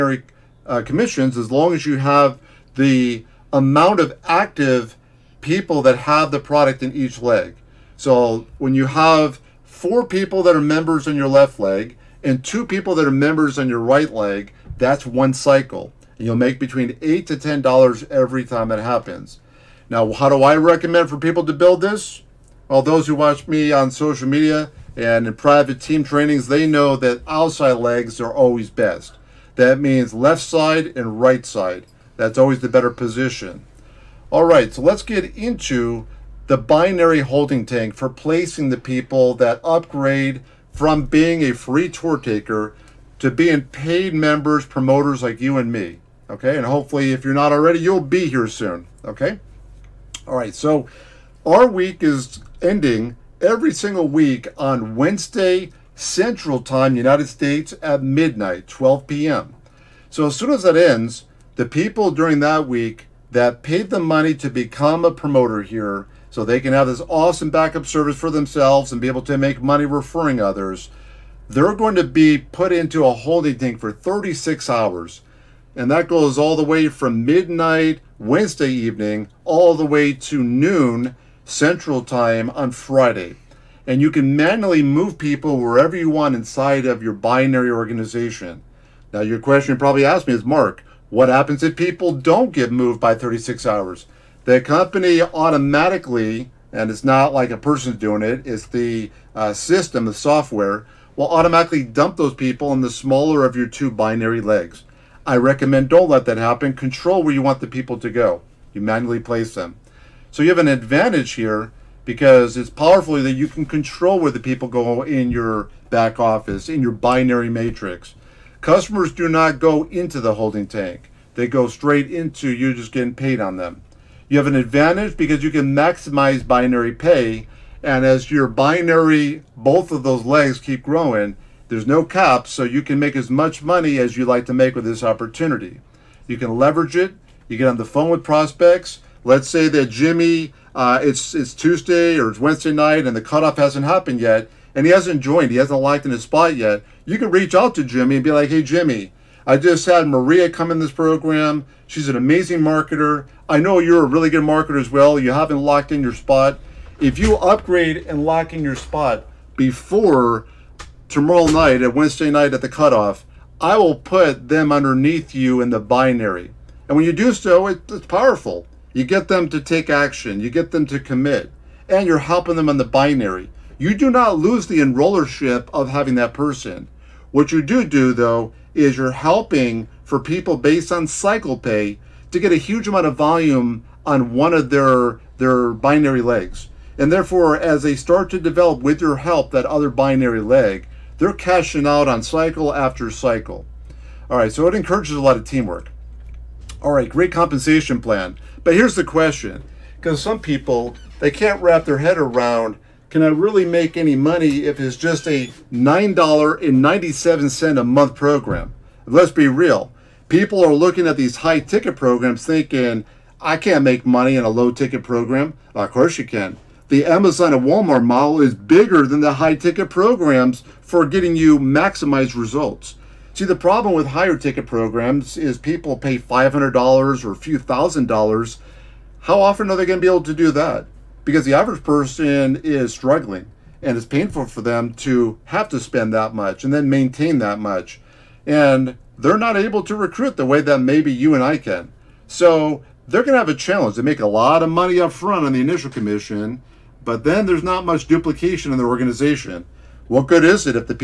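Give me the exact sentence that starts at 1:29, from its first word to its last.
Now, your question you probably asked me is Marc, what happens if people don't get moved by 36 hours?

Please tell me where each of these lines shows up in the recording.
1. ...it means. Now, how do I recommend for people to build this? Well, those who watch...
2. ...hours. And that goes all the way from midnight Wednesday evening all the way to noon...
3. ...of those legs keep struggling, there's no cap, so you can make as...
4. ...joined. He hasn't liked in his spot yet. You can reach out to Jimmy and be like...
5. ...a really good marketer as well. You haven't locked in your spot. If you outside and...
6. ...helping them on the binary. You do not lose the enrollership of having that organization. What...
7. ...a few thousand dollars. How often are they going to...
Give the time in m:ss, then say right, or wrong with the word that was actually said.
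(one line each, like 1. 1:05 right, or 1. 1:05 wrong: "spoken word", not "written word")
1. 0:18 wrong: "happens", not "means"
2. 1:14 right
3. 2:09 wrong: "growing", not "struggling"
4. 2:25 right
5. 2:34 wrong: "upgrade", not "outside"
6. 2:52 wrong: "person", not "organization"
7. 3:47 right.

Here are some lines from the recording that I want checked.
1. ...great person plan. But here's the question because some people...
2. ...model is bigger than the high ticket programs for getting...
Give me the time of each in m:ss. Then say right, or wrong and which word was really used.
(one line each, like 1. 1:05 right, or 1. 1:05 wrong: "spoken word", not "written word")
1. 3:17 wrong: "compensation", not "person"
2. 3:38 right.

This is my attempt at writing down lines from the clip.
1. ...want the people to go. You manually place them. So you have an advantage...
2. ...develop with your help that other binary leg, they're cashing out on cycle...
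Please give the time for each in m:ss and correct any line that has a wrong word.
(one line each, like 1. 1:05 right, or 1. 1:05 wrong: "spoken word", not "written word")
1. 1:47 right
2. 3:08 right.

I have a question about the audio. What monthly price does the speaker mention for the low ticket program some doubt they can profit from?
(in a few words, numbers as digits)
$9.97.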